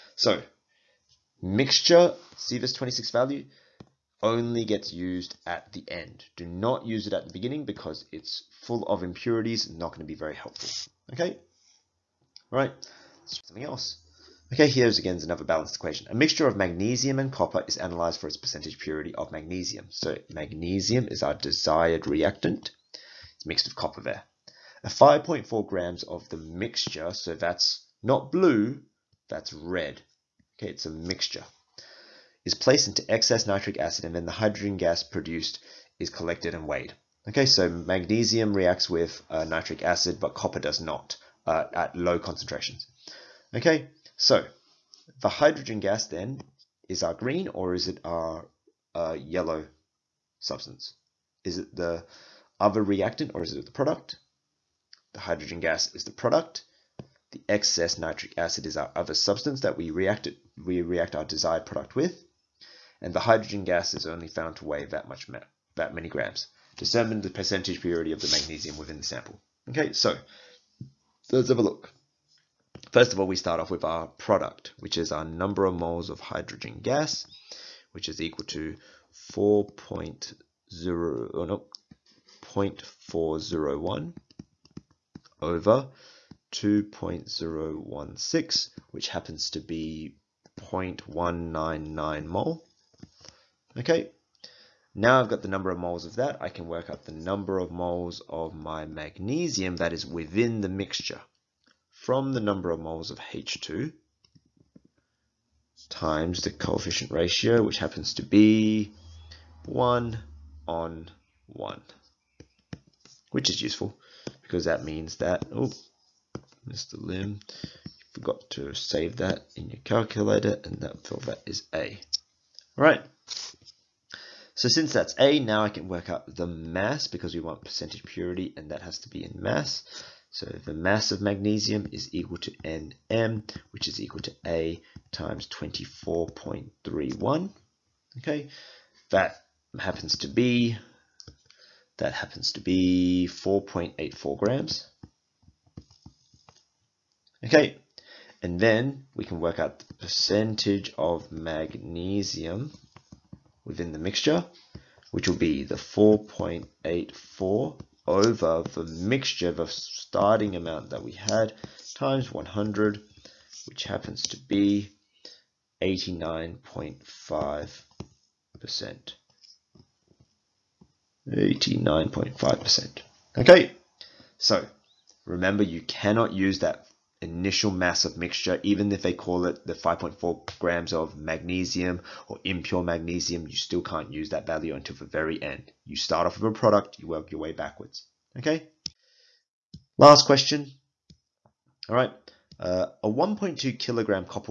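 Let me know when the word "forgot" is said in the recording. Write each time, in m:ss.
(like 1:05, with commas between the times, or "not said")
1:58.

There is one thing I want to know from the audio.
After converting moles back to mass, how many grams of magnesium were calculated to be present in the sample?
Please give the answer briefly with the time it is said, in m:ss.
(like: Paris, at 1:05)
4.84 grams, at 2:23.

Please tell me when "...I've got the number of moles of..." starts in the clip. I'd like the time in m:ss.
1:35.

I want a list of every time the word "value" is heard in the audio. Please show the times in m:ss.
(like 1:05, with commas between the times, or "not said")
0:03, 3:04.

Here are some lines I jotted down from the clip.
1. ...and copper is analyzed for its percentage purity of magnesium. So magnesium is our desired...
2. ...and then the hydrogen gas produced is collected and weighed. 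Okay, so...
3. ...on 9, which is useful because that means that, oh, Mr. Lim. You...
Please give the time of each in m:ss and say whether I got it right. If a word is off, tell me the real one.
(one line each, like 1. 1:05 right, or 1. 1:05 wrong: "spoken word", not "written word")
1. 0:17 right
2. 0:34 right
3. 1:50 wrong: "1", not "9".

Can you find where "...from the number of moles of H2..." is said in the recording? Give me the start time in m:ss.
1:41.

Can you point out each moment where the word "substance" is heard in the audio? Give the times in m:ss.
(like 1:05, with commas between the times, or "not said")
0:50, 0:59.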